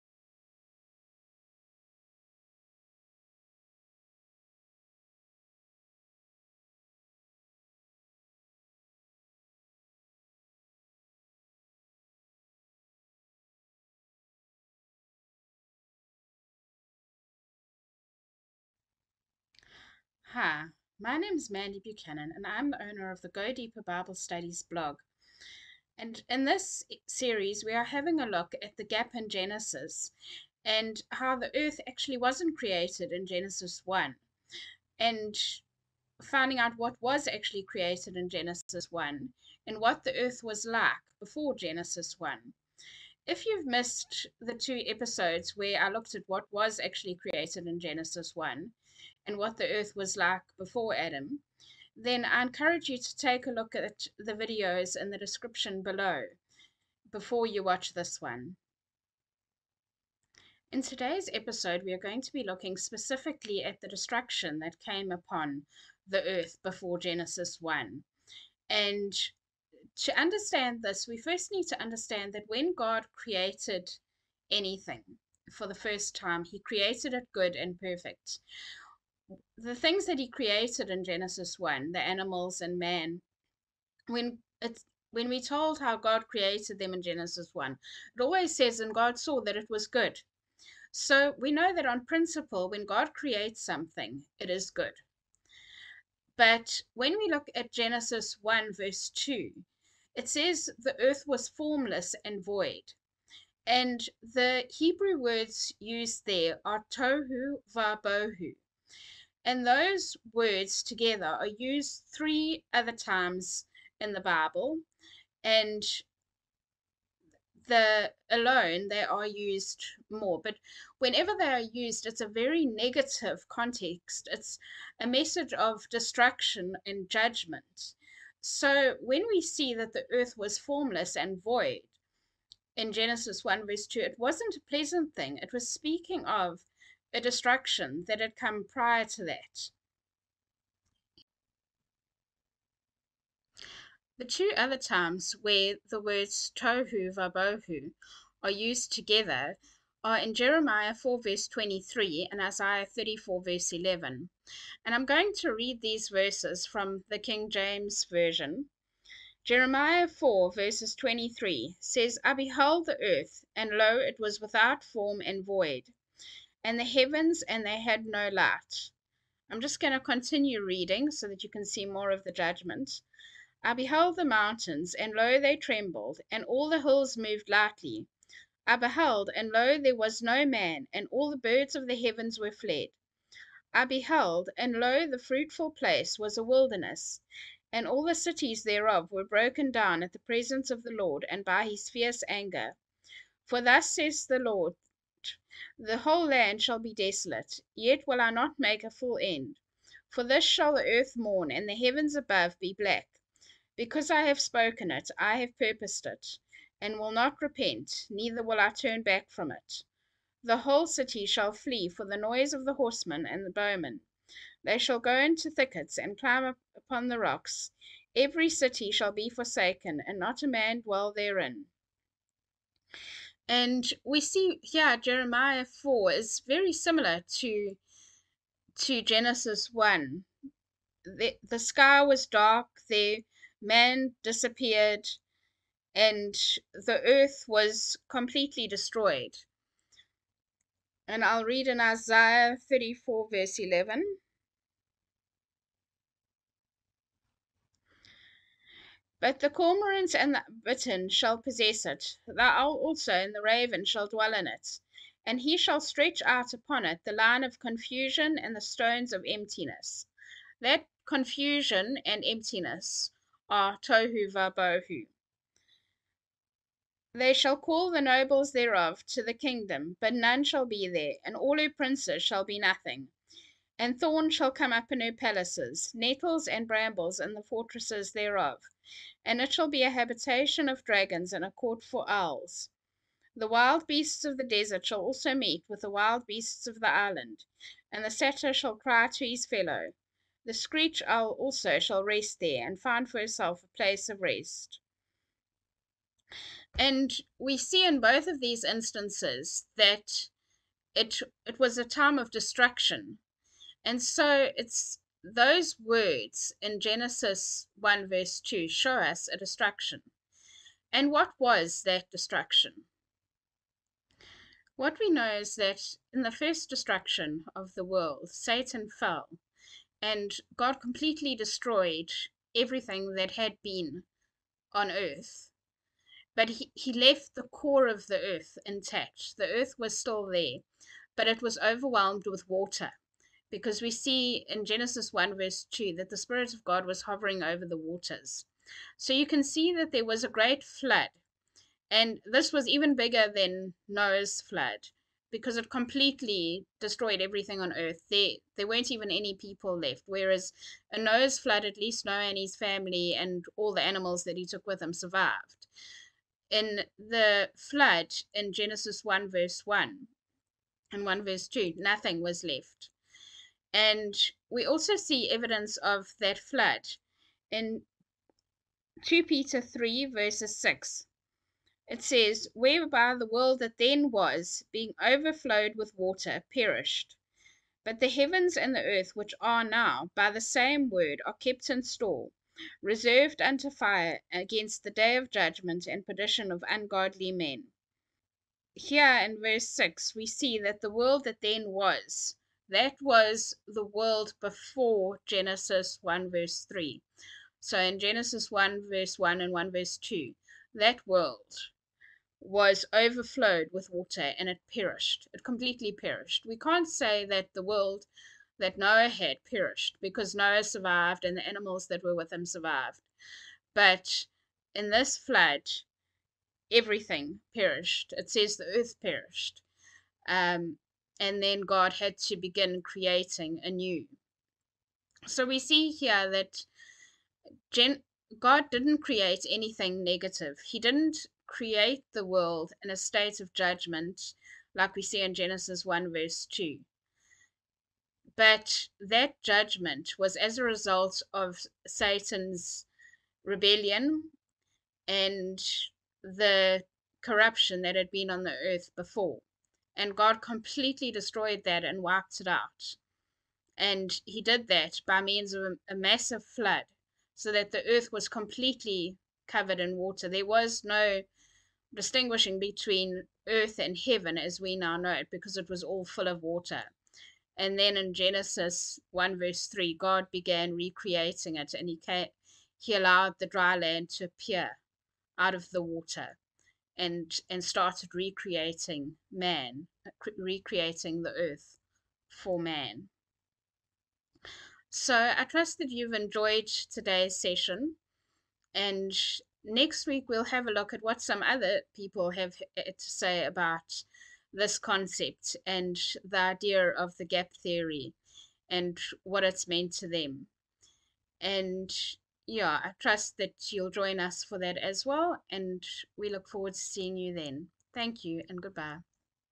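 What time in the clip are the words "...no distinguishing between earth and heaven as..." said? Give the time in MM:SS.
07:40.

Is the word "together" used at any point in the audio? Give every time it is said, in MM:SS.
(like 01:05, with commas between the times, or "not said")
01:50, 02:28.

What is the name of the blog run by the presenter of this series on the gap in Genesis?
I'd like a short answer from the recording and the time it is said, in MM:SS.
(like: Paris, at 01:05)
Go Deeper Bible Studies, at 00:23.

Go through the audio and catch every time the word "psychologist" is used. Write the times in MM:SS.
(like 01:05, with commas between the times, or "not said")
not said.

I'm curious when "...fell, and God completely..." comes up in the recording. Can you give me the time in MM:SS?
05:18.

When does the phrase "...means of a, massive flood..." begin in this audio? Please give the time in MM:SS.
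07:35.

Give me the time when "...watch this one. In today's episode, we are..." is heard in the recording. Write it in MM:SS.
00:57.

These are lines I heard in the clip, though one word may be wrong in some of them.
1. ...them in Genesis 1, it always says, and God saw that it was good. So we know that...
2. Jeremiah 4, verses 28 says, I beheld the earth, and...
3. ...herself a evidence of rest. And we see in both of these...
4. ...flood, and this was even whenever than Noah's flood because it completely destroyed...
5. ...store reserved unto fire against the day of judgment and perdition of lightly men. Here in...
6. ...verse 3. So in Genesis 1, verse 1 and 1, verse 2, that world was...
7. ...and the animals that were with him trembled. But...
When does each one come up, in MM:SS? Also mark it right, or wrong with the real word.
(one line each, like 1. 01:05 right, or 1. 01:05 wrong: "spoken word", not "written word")
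1. 01:26 right
2. 02:39 wrong: "23", not "28"
3. 04:53 wrong: "place", not "evidence"
4. 05:40 wrong: "bigger", not "whenever"
5. 06:21 wrong: "ungodly", not "lightly"
6. 06:36 right
7. 06:51 wrong: "survived", not "trembled".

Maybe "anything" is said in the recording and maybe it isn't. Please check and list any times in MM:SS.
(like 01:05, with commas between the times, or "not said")
01:14, 07:09.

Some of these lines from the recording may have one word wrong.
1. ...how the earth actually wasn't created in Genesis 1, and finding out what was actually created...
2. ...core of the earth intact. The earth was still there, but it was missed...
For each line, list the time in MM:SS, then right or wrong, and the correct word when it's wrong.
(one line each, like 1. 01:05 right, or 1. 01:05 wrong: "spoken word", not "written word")
1. 00:31 right
2. 05:27 wrong: "overwhelmed", not "missed".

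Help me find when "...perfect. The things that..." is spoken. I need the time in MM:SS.
01:17.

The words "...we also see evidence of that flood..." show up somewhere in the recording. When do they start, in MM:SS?
06:04.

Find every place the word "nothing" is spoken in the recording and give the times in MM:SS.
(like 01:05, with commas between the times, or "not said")
04:32, 06:01.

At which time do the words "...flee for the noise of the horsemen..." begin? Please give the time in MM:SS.
03:31.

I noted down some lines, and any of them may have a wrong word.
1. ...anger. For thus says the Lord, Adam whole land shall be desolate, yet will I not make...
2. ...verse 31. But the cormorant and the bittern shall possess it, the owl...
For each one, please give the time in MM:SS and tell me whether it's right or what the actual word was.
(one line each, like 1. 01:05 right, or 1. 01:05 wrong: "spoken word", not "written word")
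1. 03:12 wrong: "The", not "Adam"
2. 04:03 wrong: "11", not "31".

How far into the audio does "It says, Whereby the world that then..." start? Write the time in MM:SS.
06:11.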